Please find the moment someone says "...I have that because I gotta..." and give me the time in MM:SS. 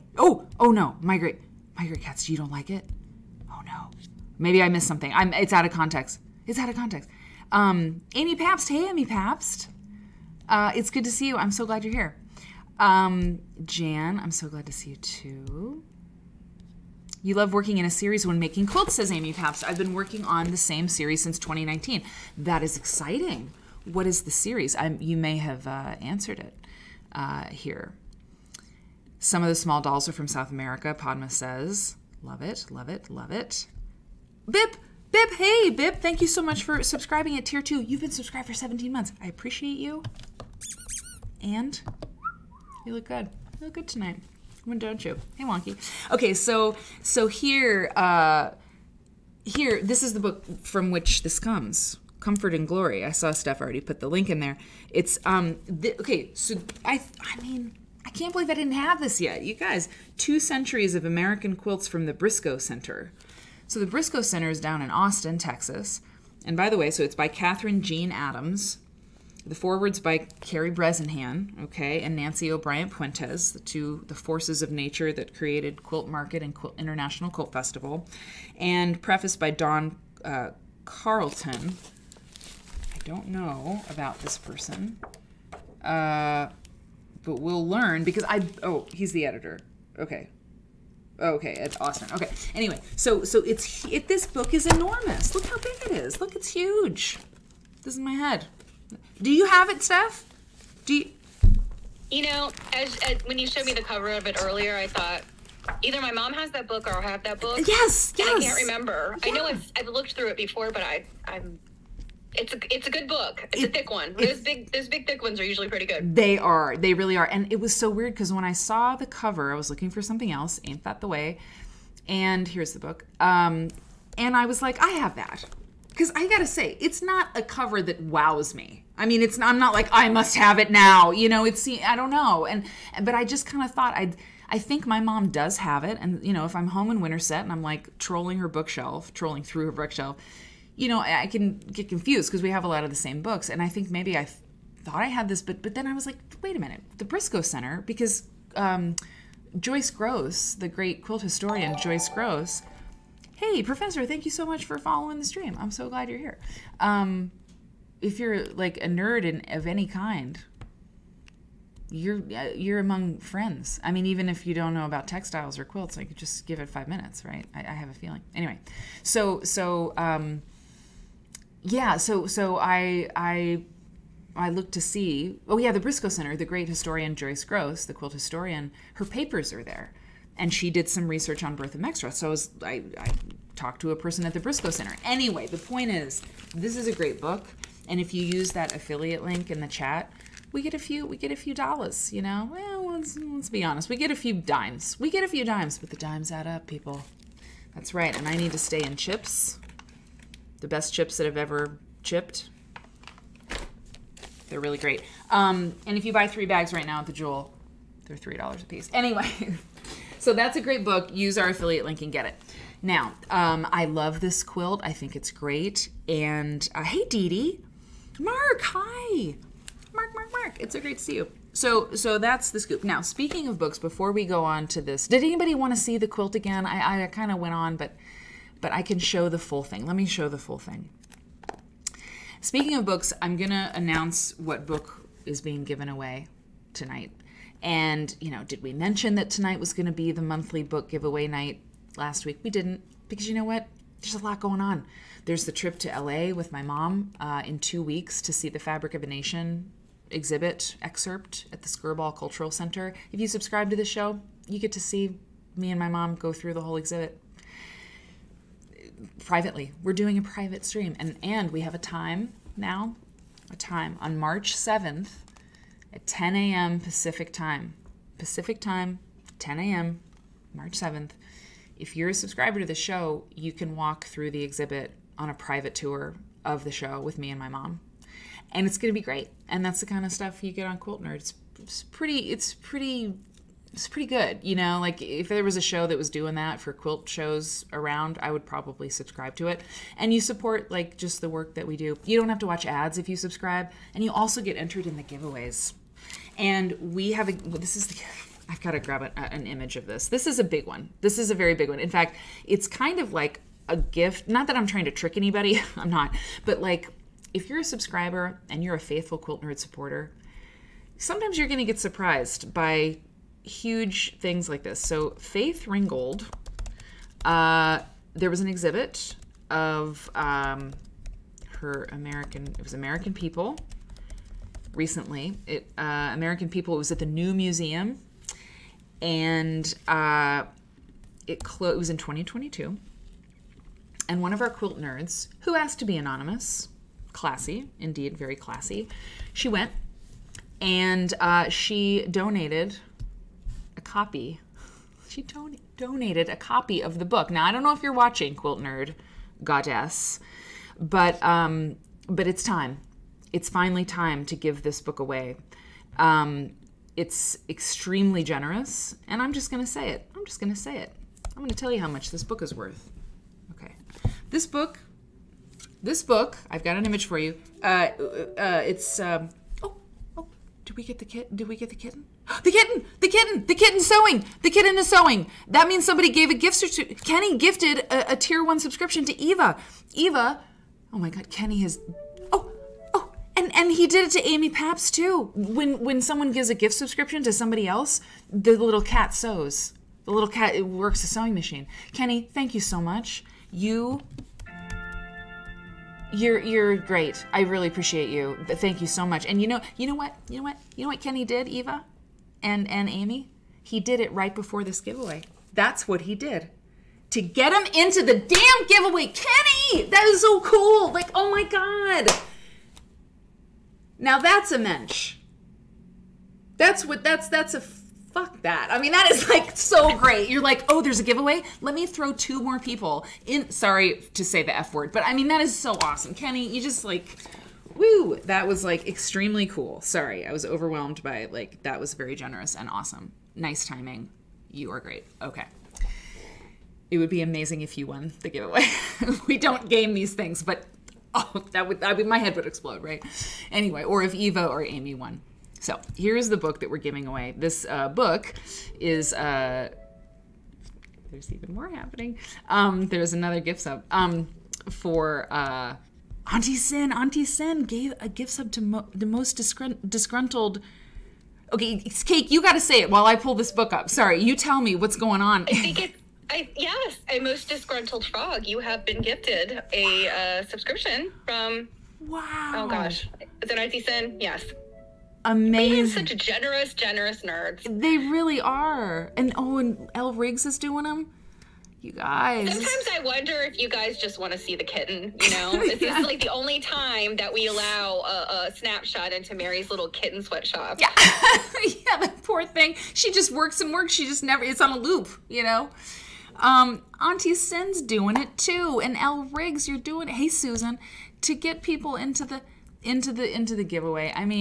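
02:04.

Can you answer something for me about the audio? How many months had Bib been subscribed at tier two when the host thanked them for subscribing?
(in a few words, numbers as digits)
17.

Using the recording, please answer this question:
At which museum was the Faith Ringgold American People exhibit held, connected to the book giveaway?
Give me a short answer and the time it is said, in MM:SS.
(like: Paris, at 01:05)
New Museum, at 05:27.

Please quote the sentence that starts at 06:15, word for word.
That means somebody gave a gift to Kenny gifted a, a tier one subscription to Eva.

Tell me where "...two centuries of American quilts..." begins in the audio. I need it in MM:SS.
01:00.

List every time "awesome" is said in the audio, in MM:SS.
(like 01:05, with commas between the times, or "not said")
07:05, 07:12.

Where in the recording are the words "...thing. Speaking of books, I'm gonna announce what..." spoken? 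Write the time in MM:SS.
03:50.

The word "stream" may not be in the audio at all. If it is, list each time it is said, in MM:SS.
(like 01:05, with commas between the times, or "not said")
02:35, 04:20.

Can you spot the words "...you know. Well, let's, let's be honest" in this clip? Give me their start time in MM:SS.
03:12.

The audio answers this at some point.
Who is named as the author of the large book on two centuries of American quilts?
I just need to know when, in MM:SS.
01:07.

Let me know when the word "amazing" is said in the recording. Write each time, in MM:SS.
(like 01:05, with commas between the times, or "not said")
07:17, 07:55.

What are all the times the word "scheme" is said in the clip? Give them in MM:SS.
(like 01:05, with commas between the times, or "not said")
not said.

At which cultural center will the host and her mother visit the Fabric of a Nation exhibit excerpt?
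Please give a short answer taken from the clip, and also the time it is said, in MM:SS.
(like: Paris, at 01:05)
Skirball Cultural Center, at 04:11.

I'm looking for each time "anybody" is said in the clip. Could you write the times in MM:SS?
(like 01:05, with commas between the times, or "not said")
03:45, 05:05.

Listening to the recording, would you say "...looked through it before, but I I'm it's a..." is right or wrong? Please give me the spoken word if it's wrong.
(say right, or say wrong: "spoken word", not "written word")
right.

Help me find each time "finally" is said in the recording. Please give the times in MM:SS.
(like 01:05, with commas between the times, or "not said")
05:53.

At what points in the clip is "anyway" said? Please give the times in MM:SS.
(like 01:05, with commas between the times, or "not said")
01:32, 02:48, 03:05, 03:28, 07:23.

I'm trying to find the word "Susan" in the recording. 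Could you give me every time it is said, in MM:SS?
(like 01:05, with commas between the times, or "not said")
08:20.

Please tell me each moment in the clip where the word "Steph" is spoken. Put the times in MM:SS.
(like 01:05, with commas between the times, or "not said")
00:53, 01:39.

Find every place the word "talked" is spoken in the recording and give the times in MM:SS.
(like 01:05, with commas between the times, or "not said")
03:03.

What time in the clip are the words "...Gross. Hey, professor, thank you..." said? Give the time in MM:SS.
02:32.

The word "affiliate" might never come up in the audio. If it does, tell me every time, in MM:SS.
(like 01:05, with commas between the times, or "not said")
03:08, 03:31.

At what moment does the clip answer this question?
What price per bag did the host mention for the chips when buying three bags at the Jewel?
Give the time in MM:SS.
03:28.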